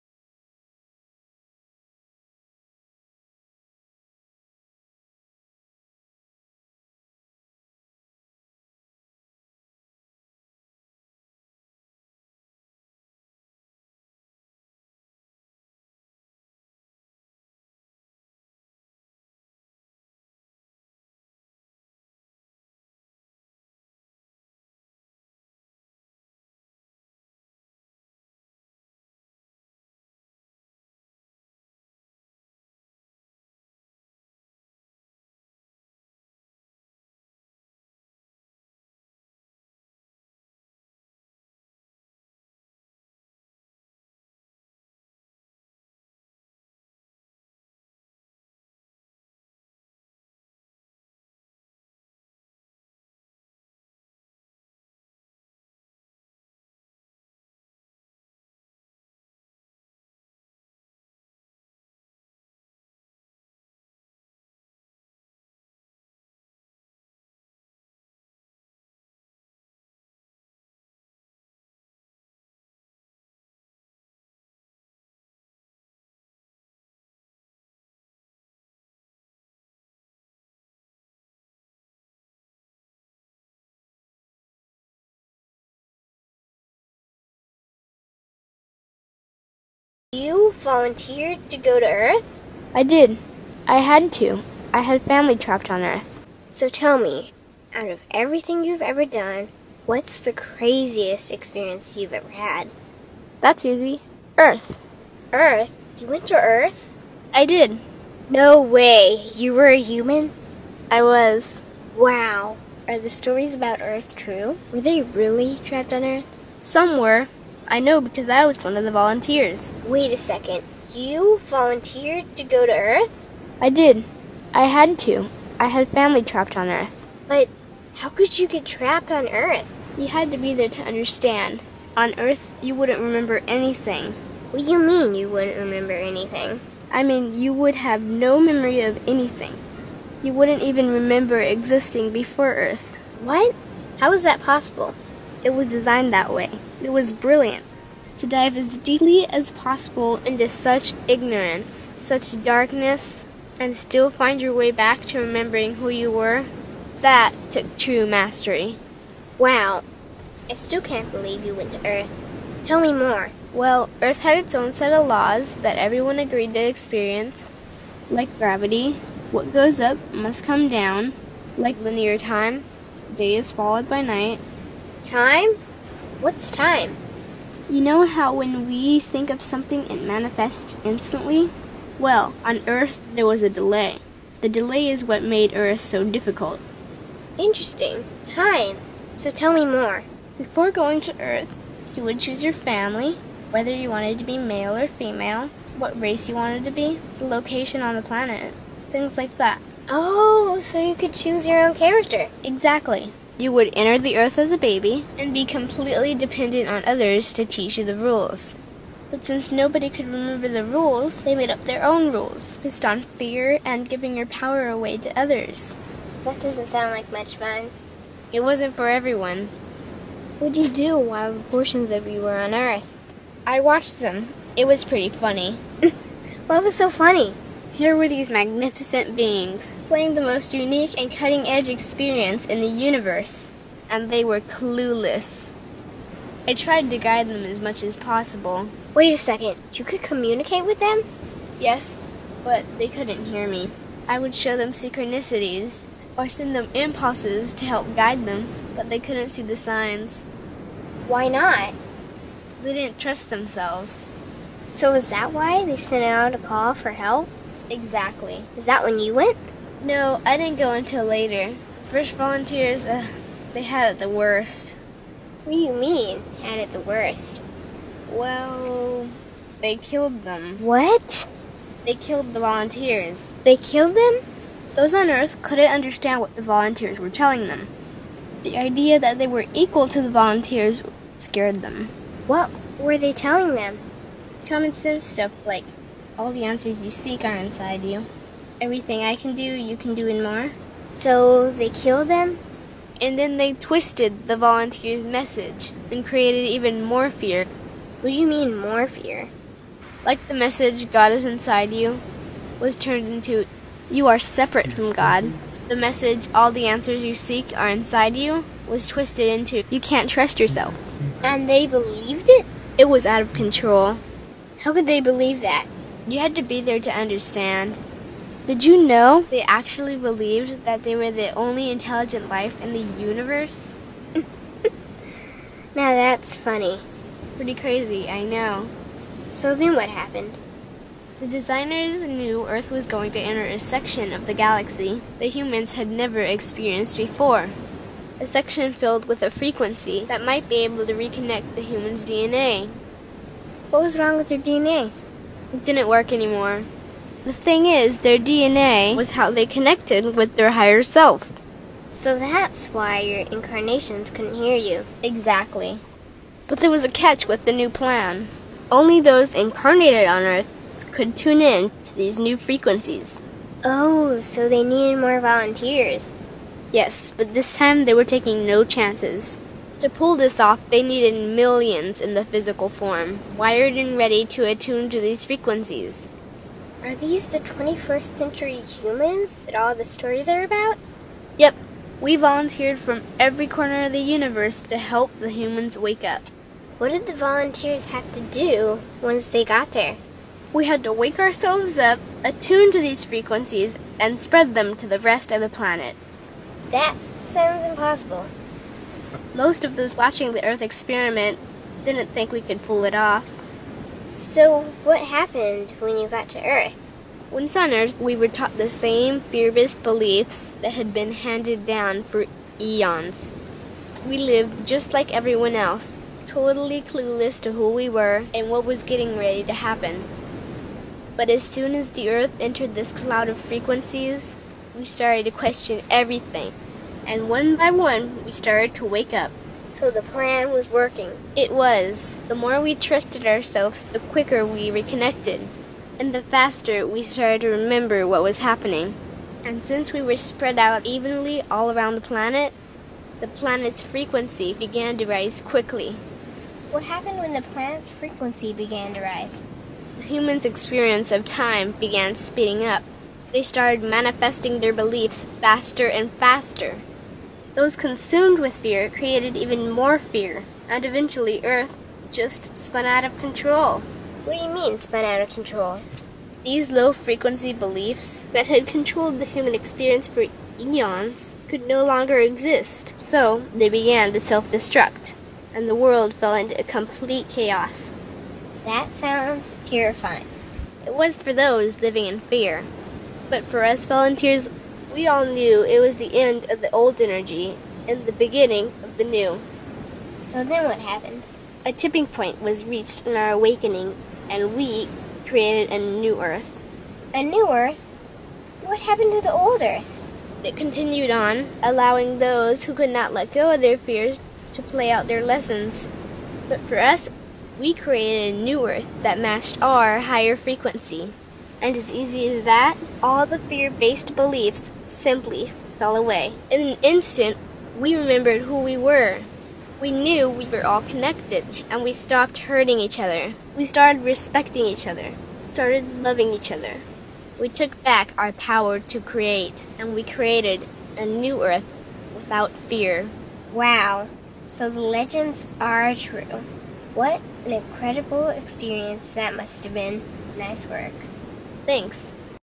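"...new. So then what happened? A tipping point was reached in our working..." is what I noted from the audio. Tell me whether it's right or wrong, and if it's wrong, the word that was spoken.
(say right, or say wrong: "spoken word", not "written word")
wrong: "awakening", not "working".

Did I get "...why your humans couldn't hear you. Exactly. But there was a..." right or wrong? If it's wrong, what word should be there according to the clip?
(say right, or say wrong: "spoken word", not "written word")
wrong: "incarnations", not "humans".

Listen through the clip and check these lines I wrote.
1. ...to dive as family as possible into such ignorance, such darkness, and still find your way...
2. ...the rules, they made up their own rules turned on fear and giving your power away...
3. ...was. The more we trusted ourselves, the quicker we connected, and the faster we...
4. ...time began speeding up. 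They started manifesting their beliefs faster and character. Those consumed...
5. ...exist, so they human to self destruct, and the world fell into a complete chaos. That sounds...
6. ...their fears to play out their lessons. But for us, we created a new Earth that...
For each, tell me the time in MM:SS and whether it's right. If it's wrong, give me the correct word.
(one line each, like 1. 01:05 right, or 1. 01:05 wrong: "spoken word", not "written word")
1. 02:28 wrong: "deeply", not "family"
2. 03:30 wrong: "based", not "turned"
3. 07:11 wrong: "reconnected", not "connected"
4. 07:31 wrong: "faster", not "character"
5. 07:52 wrong: "began", not "human"
6. 08:23 right.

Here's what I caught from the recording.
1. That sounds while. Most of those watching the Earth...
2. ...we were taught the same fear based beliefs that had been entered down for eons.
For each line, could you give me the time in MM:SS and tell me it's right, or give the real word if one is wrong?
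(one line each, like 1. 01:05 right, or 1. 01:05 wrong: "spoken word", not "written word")
1. 06:36 wrong: "impossible", not "while"
2. 06:47 wrong: "handed", not "entered".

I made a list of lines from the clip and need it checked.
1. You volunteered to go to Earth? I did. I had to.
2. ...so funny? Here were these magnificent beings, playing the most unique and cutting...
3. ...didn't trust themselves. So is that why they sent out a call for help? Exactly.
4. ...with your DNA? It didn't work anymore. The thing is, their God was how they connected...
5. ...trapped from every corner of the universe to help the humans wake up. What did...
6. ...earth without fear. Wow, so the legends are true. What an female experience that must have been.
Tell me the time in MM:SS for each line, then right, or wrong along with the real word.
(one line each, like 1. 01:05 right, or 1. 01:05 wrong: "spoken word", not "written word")
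1. 02:00 right
2. 03:46 right
3. 04:12 right
4. 05:44 wrong: "DNA", not "God"
5. 06:22 wrong: "volunteered", not "trapped"
6. 08:51 wrong: "incredible", not "female".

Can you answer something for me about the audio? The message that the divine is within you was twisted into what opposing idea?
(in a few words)
You are separate from God.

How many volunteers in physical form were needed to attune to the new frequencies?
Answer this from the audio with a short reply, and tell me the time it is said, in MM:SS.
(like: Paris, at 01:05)
Millions, at 06:11.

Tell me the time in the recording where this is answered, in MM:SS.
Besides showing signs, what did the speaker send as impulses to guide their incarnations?
04:04.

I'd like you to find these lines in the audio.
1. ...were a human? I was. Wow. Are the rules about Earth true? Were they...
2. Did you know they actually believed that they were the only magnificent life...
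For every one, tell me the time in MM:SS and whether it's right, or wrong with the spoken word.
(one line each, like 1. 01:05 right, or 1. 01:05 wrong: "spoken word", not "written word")
1. 01:49 wrong: "stories", not "rules"
2. 05:18 wrong: "intelligent", not "magnificent".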